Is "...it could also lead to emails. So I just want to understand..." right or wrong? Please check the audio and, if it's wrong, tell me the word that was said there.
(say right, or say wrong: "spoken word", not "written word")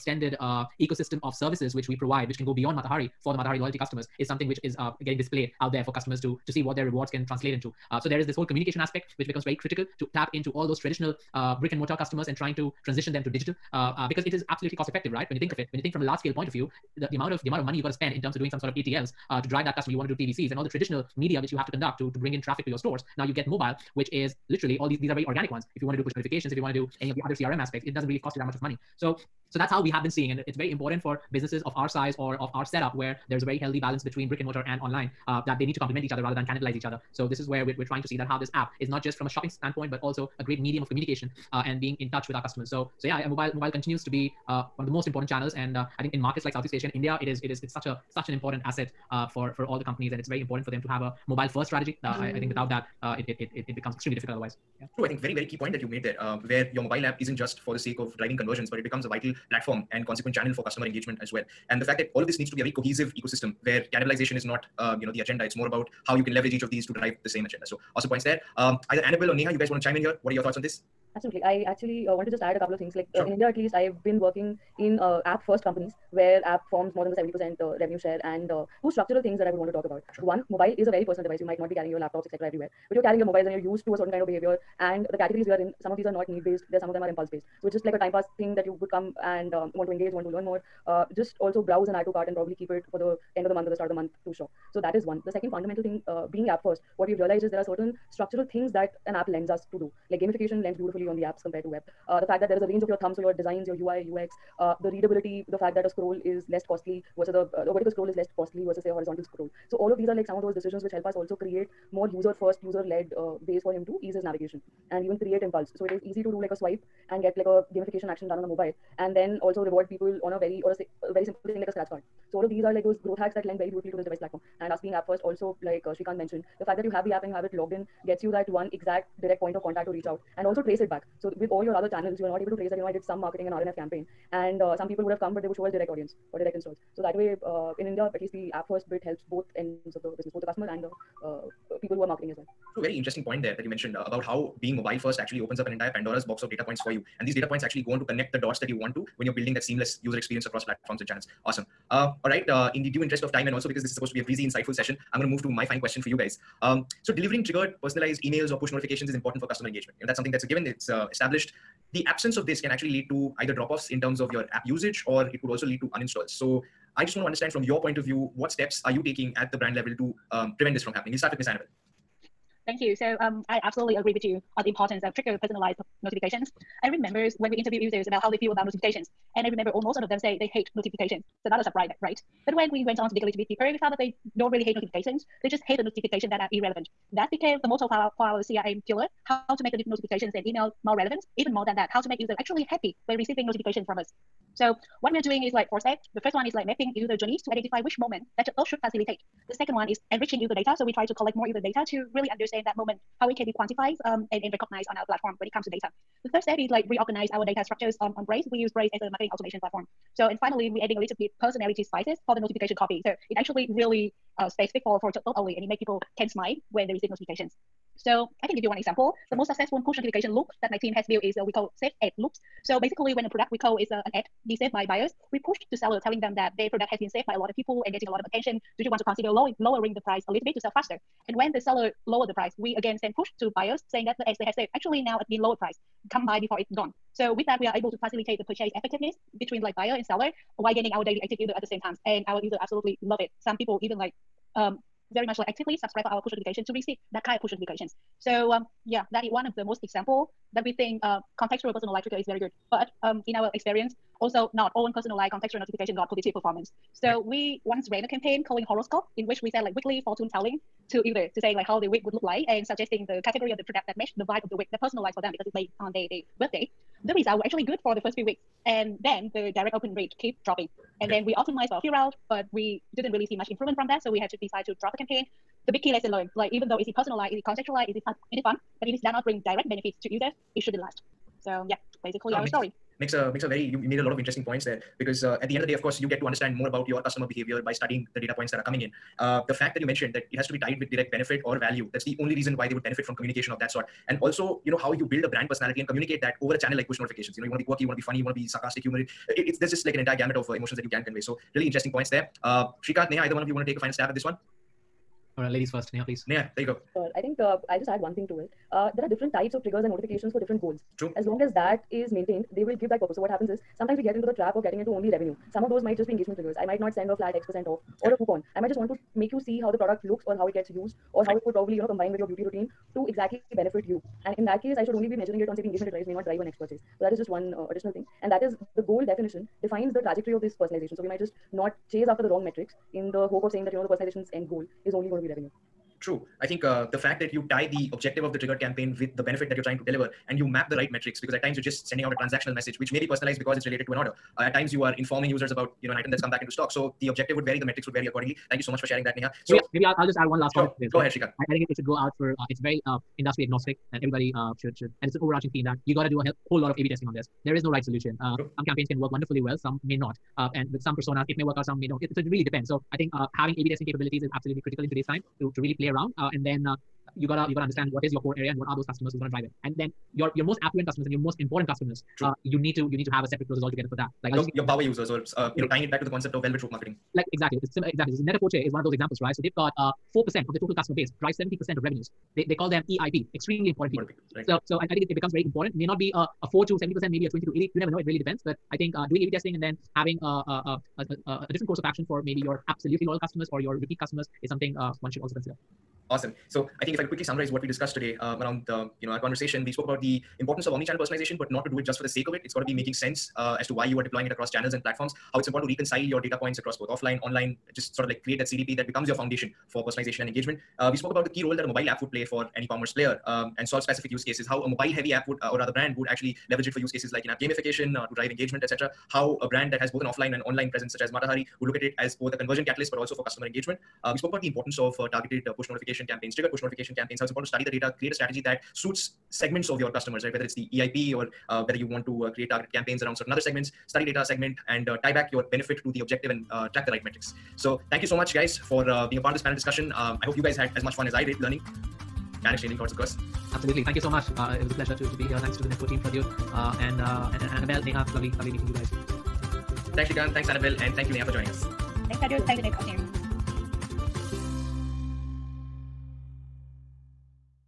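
wrong: "uninstalls", not "emails".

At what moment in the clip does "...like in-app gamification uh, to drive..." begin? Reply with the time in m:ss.
6:57.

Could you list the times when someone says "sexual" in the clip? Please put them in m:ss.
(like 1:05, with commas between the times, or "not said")
not said.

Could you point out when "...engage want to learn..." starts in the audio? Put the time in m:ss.
1:29.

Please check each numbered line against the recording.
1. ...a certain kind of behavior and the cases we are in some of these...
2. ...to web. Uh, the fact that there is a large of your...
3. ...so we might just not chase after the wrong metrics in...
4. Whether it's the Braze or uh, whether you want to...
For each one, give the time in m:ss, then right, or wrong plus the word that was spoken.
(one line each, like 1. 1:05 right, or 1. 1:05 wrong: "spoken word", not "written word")
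1. 1:23 wrong: "categories", not "cases"
2. 1:41 wrong: "range", not "large"
3. 5:30 right
4. 7:10 wrong: "EIP", not "Braze".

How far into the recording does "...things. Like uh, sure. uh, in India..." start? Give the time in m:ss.
1:12.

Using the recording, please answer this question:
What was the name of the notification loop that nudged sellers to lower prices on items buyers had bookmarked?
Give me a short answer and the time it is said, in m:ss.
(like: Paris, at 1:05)
safe ad loops, at 3:41.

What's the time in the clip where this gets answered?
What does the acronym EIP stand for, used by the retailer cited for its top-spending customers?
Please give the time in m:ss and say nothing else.
6:23.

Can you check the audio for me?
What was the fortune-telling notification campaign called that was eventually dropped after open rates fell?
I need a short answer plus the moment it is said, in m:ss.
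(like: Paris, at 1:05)
horoscope, at 4:18.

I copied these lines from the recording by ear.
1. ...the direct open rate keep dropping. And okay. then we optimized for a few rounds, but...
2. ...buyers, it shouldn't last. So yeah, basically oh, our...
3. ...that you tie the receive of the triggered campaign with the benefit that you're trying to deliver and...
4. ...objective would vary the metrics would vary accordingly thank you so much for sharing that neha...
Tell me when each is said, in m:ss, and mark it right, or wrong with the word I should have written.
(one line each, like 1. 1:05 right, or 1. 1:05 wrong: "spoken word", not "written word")
1. 4:29 right
2. 4:40 wrong: "users", not "buyers"
3. 5:37 wrong: "objective", not "receive"
4. 5:47 right.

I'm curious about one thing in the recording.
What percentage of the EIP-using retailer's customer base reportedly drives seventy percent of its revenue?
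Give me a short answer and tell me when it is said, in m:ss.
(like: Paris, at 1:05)
4%, at 6:20.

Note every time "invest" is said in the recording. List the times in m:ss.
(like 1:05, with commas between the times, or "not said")
not said.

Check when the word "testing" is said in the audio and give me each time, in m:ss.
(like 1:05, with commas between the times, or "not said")
5:56, 6:03, 6:29.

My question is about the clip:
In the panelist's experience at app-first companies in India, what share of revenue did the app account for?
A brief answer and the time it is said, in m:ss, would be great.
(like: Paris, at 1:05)
more than 70%, at 1:16.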